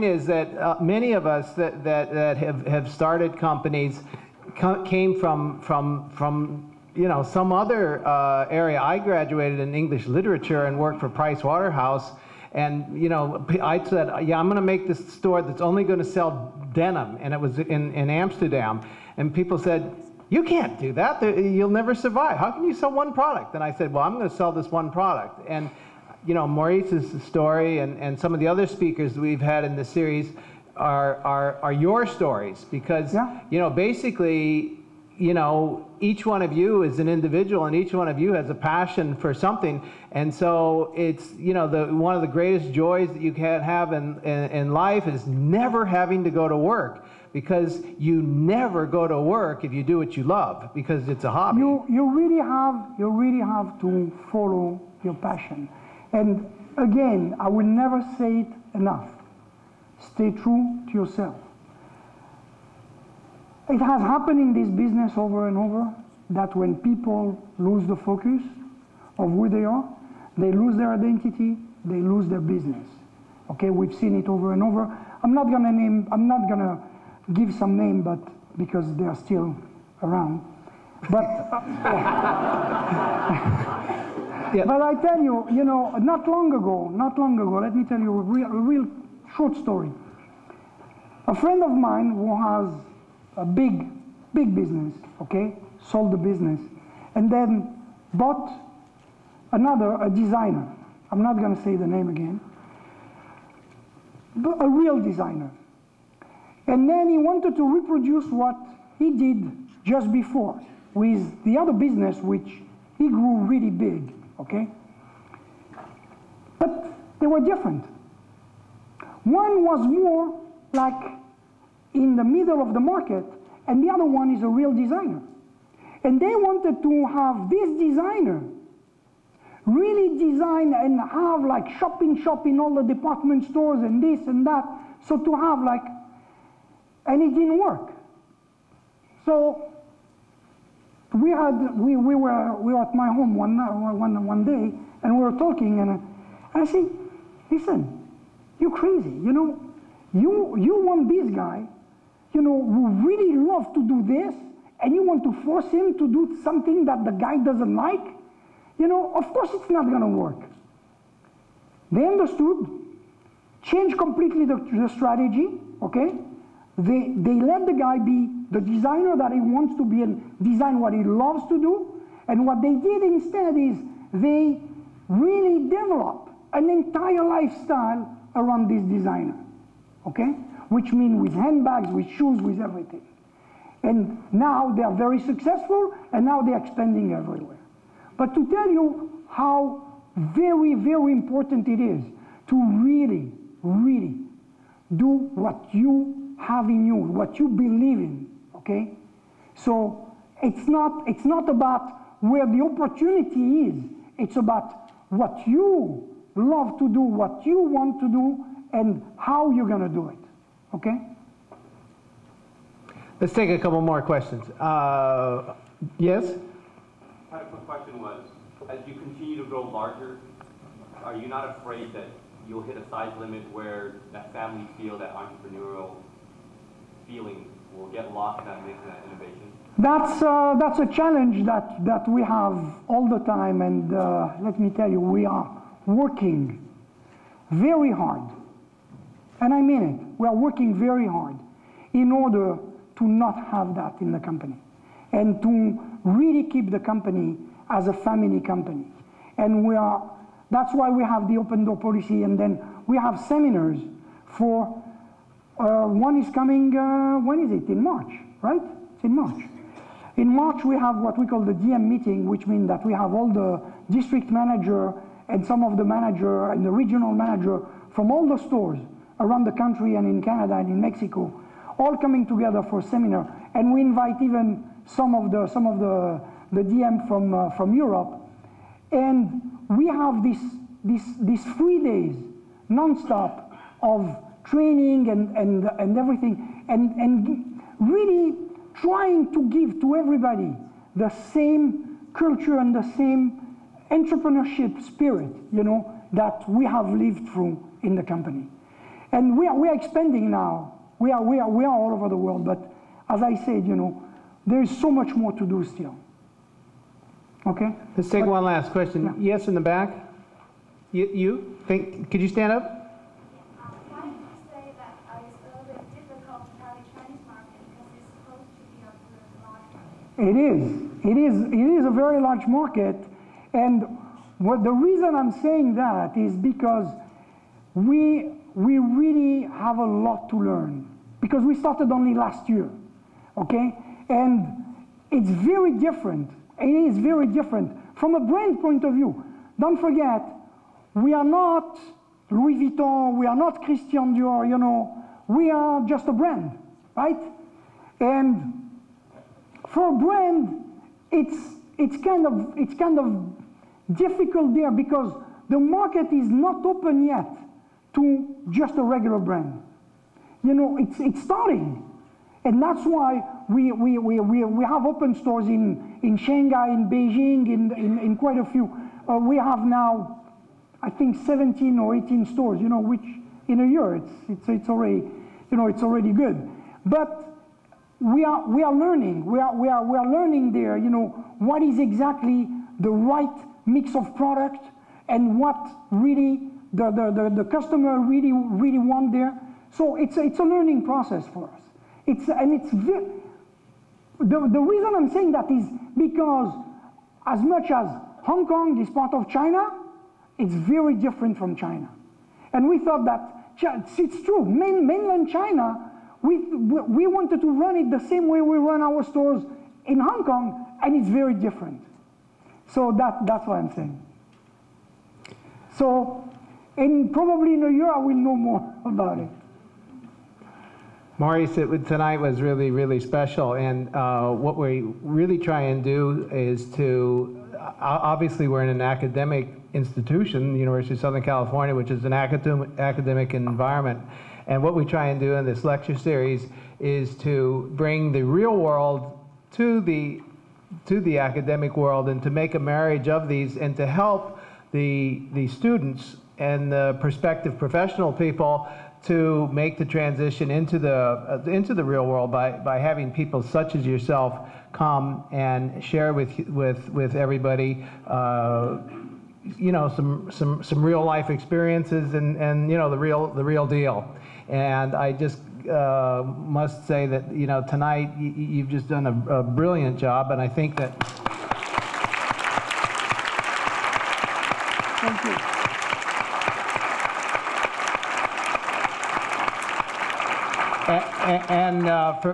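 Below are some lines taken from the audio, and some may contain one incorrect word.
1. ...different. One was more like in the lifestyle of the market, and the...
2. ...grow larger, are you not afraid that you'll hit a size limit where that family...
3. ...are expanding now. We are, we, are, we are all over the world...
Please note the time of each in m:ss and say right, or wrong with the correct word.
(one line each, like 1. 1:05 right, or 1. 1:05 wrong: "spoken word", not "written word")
1. 1:57 wrong: "middle", not "lifestyle"
2. 3:39 right
3. 4:59 right.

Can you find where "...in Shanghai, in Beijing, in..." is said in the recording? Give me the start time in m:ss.
6:06.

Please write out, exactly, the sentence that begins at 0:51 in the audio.
You, you really have, you really have to follow your passion.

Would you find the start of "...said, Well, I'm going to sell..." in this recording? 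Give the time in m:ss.
0:23.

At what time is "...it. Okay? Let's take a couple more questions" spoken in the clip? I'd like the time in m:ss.
3:30.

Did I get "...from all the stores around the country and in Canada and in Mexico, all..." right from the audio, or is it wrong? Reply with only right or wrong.
right.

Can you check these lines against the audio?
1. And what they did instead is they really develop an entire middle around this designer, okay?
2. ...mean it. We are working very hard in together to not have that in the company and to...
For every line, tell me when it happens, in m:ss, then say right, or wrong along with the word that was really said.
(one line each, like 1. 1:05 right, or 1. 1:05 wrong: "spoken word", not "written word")
1. 2:52 wrong: "lifestyle", not "middle"
2. 3:59 wrong: "order", not "together".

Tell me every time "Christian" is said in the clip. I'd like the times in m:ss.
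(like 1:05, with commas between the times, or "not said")
5:43.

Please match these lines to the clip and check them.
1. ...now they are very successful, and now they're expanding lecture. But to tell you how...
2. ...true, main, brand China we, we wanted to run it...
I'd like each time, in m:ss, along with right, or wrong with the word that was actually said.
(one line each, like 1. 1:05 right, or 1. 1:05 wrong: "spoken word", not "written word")
1. 3:04 wrong: "everywhere", not "lecture"
2. 6:44 wrong: "mainland", not "brand".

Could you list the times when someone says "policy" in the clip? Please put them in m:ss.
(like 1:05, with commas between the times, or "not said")
4:11.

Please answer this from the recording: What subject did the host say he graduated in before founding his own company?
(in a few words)
English literature.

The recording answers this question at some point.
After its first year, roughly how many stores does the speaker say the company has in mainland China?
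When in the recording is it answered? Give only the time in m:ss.
6:11.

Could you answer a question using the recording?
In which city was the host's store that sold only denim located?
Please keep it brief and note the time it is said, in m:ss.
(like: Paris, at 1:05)
Amsterdam, at 0:18.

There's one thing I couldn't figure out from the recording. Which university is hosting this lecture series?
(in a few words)
University of Southern California.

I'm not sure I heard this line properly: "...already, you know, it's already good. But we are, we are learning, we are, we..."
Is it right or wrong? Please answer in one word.
right.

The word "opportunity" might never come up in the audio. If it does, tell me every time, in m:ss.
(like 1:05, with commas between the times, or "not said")
3:22.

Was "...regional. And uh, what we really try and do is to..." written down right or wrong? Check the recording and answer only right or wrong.
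wrong.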